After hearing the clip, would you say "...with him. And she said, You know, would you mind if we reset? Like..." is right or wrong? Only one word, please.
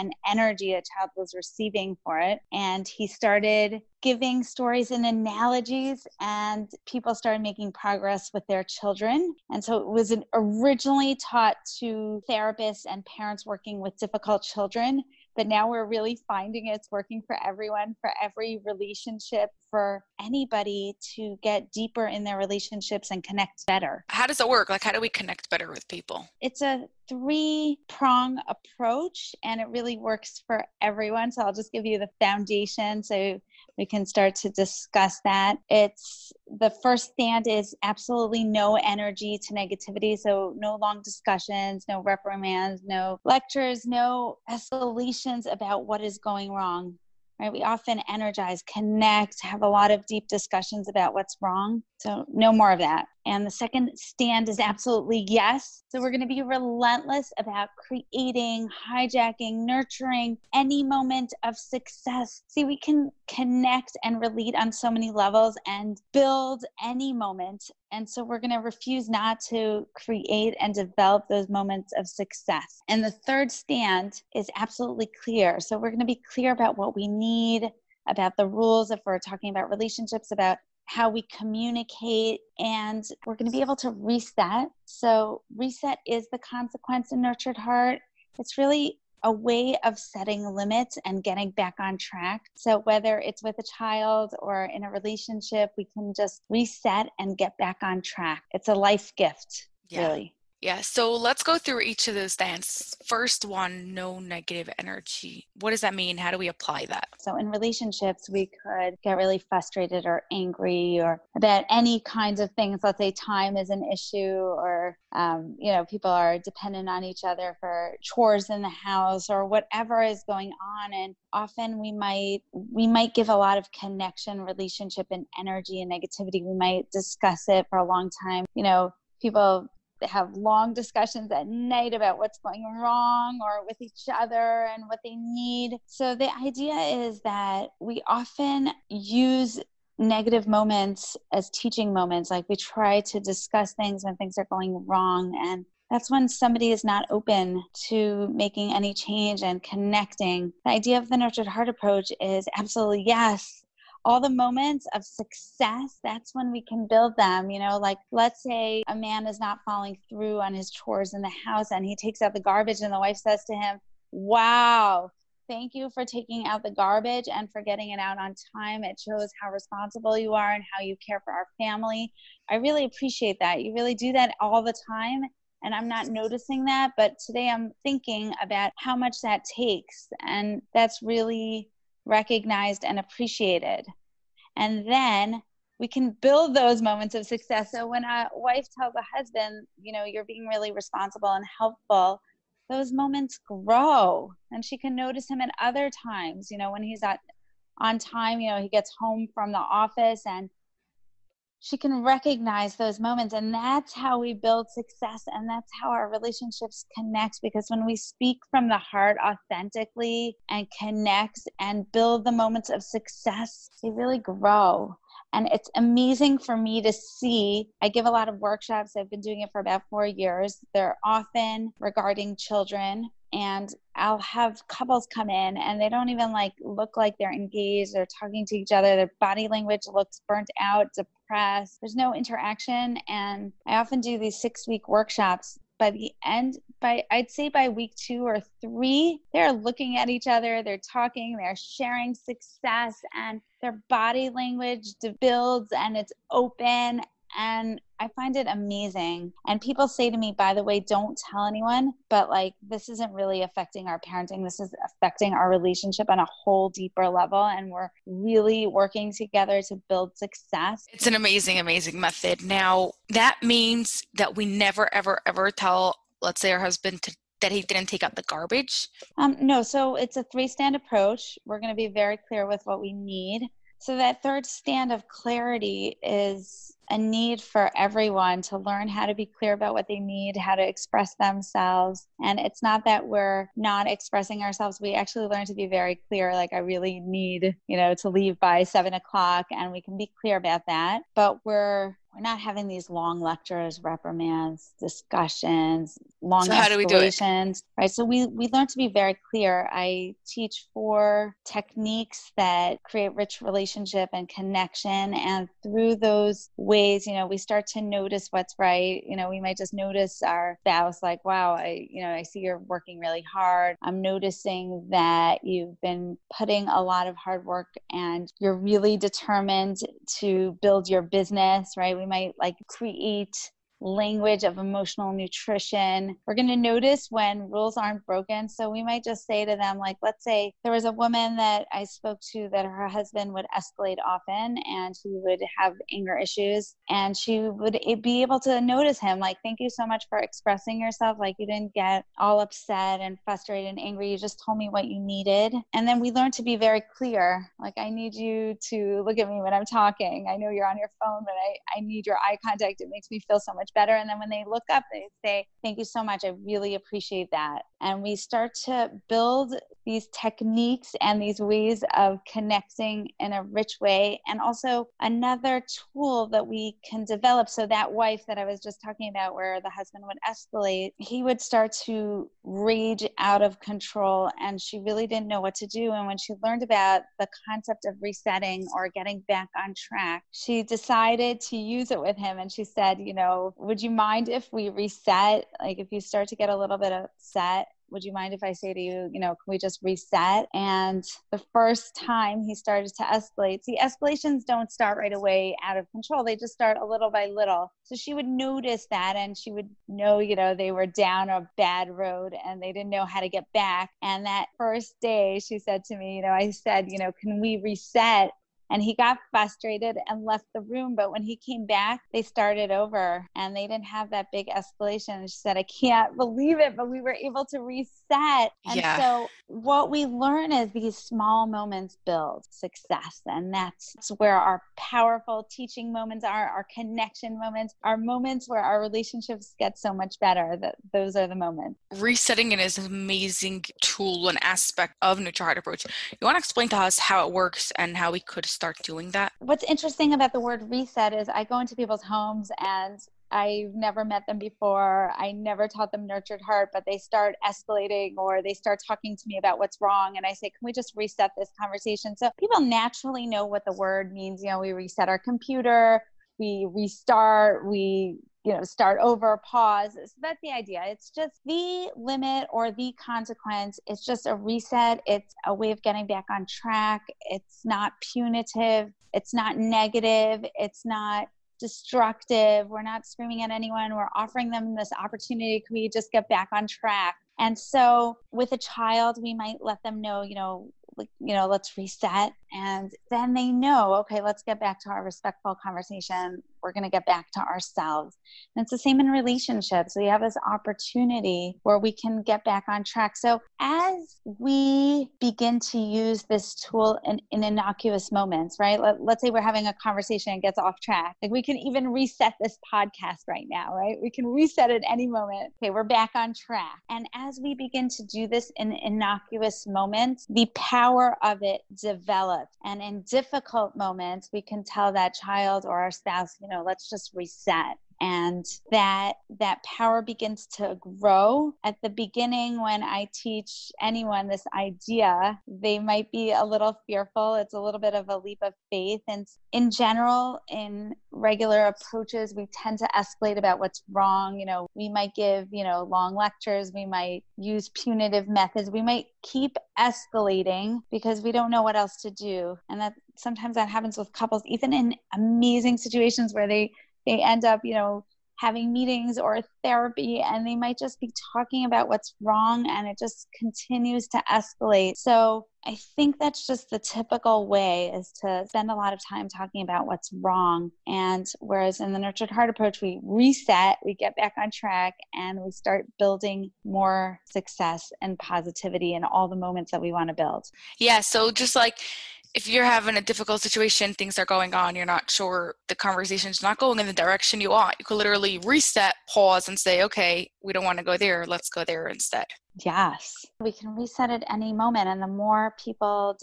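right.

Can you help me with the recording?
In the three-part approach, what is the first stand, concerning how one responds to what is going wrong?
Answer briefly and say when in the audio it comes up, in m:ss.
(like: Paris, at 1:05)
No energy to negativity, at 0:38.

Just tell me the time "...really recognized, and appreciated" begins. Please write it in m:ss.
3:01.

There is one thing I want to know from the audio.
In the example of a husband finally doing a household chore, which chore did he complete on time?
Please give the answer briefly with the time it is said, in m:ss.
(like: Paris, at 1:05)
Taking out the garbage, at 2:41.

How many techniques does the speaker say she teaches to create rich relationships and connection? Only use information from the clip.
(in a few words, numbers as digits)
4.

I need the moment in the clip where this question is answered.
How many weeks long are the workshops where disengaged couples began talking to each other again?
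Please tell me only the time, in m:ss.
3:54.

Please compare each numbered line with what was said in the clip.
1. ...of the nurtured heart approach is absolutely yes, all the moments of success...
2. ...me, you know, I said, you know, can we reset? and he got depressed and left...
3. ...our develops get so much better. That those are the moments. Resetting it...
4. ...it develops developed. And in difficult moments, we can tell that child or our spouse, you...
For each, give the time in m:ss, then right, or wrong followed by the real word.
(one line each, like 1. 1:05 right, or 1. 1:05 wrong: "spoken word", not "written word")
1. 2:30 right
2. 6:45 wrong: "frustrated", not "depressed"
3. 7:08 wrong: "relationships", not "develops"
4. 8:31 right.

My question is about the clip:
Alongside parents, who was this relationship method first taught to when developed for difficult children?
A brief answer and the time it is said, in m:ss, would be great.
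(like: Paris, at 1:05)
Therapists, at 0:12.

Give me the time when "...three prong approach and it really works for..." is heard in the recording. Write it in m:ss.
0:27.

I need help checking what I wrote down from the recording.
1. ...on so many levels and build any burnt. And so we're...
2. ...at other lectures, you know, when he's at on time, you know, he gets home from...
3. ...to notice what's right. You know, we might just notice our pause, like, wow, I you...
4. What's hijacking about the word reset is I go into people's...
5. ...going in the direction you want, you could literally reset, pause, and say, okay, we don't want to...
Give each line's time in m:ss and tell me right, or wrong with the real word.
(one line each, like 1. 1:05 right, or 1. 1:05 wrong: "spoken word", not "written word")
1. 1:04 wrong: "moment", not "burnt"
2. 3:15 wrong: "times", not "lectures"
3. 5:07 wrong: "spouse", not "pause"
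4. 7:19 wrong: "interesting", not "hijacking"
5. 9:36 right.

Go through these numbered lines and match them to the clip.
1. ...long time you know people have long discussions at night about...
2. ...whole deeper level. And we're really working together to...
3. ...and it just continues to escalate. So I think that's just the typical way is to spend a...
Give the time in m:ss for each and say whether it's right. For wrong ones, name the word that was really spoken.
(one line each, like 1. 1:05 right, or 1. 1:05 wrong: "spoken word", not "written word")
1. 2:07 right
2. 4:16 right
3. 9:12 right.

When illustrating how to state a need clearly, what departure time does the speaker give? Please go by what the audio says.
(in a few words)
7 o'clock.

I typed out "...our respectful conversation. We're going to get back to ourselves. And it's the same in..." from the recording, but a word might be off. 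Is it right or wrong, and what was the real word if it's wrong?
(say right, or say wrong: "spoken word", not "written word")
right.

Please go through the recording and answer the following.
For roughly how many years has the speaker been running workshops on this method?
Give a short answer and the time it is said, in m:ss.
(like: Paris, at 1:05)
4 years, at 3:39.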